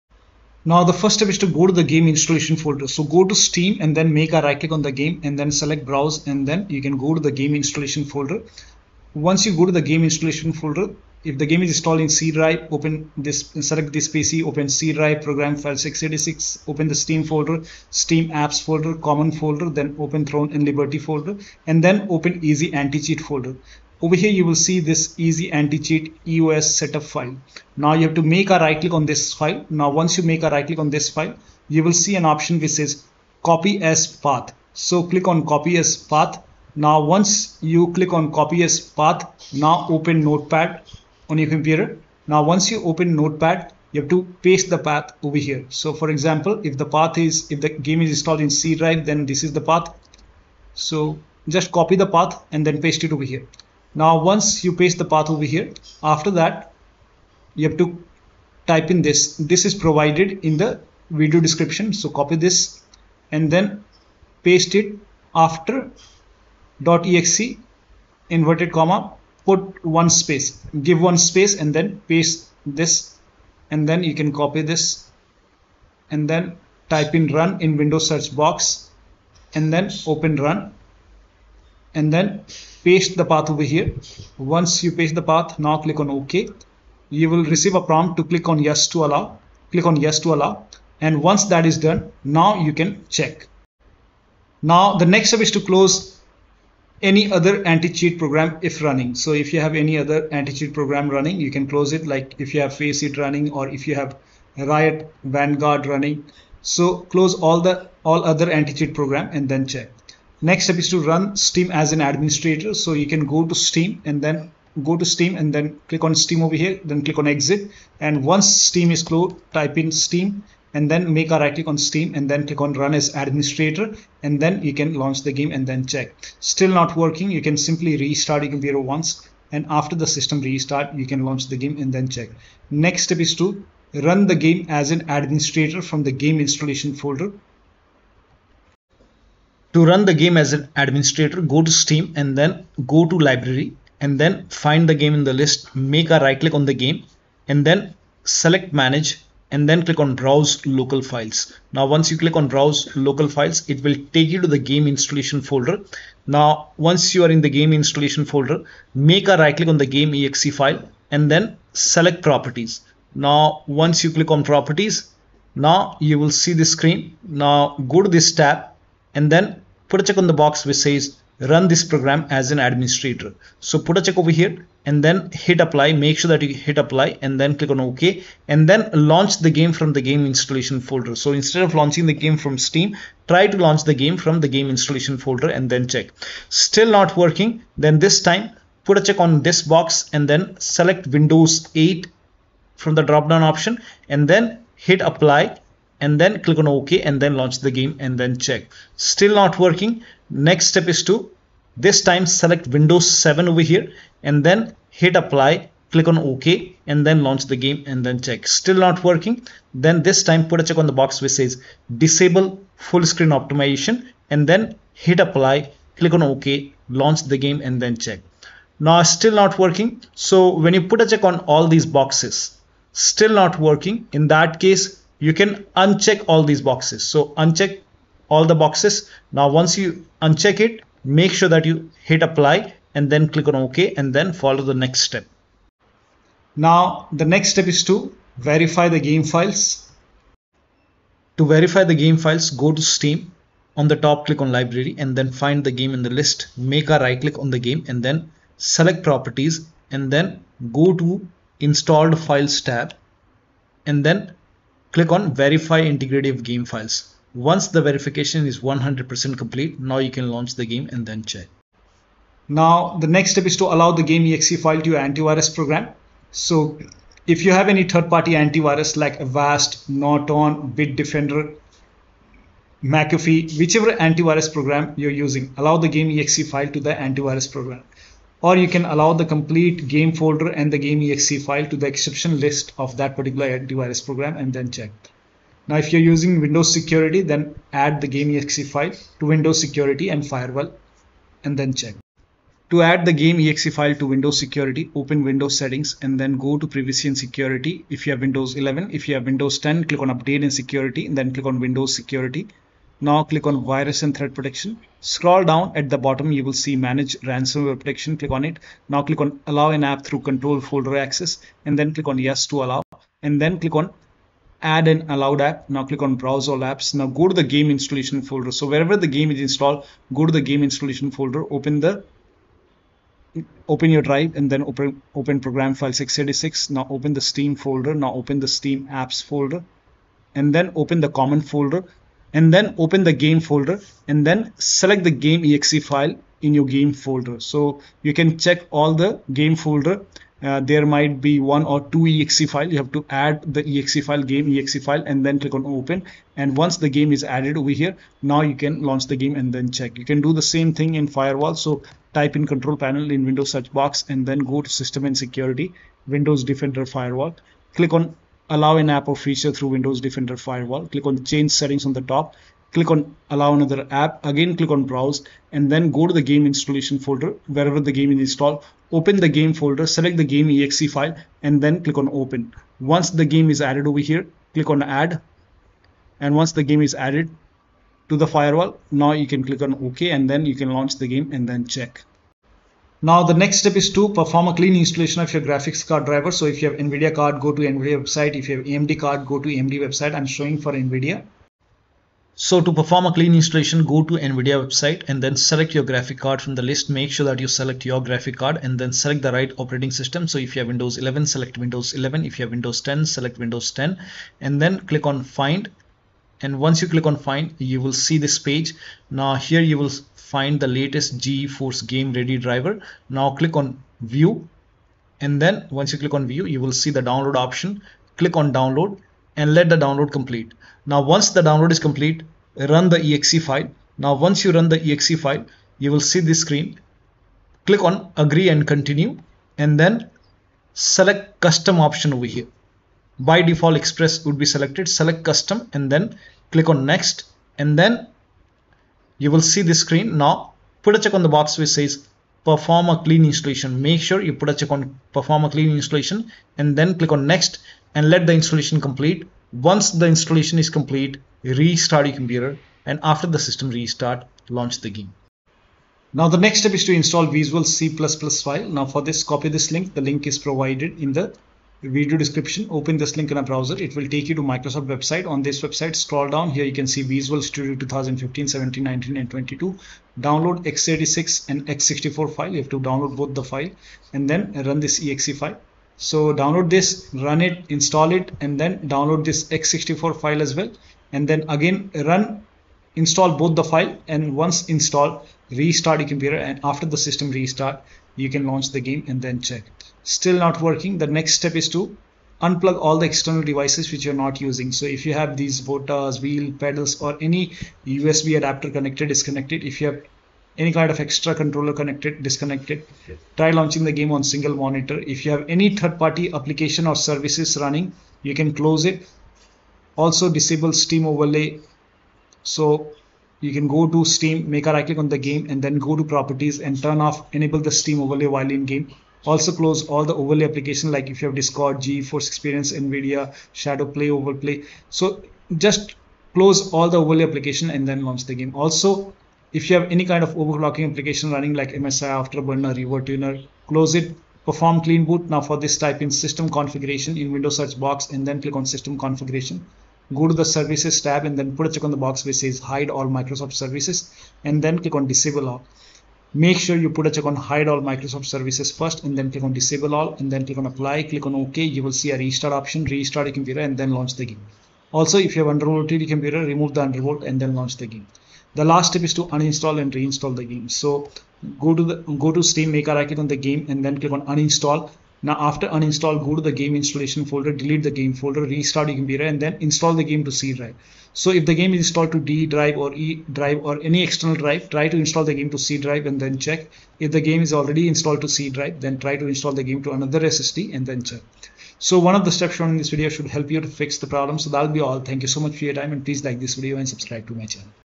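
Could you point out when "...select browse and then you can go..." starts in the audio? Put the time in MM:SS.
00:05.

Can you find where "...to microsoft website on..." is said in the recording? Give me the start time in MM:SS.
07:44.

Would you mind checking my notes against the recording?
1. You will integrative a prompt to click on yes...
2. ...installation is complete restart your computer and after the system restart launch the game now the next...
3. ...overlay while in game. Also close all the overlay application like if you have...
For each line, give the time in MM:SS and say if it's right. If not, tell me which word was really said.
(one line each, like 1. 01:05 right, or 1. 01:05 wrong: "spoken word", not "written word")
1. 01:27 wrong: "receive", not "integrative"
2. 07:30 right
3. 08:37 right.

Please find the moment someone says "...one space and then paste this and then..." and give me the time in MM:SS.
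01:11.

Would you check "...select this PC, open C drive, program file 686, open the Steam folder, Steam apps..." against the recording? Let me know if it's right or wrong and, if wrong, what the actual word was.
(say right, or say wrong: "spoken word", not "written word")
right.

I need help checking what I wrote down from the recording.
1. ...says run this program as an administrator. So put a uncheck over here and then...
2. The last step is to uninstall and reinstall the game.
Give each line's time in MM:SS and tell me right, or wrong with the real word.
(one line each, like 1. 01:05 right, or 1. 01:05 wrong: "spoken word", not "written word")
1. 02:50 wrong: "check", not "uncheck"
2. 09:18 right.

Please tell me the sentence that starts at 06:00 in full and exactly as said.
Click on change settings on the top.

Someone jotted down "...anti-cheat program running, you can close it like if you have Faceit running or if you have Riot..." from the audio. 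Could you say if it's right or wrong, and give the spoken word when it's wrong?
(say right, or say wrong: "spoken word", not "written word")
right.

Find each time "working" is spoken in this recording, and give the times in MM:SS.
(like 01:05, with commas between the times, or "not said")
02:06, 03:07, 03:19, 03:29, 03:39, 03:43, 08:10.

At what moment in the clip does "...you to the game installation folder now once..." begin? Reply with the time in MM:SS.
02:34.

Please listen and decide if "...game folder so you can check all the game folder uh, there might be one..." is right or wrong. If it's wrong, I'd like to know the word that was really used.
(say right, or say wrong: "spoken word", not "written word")
right.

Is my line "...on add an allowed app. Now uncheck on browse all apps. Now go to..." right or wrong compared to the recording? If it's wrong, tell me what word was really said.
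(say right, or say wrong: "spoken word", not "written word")
wrong: "click", not "uncheck".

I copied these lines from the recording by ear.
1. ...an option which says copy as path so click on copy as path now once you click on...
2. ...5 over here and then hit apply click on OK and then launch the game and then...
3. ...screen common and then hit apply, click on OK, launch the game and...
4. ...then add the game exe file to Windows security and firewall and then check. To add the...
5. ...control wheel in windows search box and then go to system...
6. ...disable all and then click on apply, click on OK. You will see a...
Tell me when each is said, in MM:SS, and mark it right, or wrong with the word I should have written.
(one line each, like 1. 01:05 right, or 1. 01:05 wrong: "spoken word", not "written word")
1. 00:32 right
2. 03:23 wrong: "7", not "5"
3. 03:33 wrong: "optimization", not "common"
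4. 04:47 right
5. 05:52 wrong: "panel", not "wheel"
6. 09:09 right.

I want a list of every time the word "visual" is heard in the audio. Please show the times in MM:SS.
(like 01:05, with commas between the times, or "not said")
07:37, 07:47.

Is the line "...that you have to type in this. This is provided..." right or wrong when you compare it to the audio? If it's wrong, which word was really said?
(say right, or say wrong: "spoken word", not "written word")
right.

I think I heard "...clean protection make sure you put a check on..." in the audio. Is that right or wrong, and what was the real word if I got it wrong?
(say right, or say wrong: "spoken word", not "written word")
wrong: "installation", not "protection".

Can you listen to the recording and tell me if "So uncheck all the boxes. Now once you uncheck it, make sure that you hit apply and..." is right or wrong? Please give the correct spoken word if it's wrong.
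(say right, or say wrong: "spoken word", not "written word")
right.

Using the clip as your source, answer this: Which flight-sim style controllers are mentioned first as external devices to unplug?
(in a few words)
HOTAS.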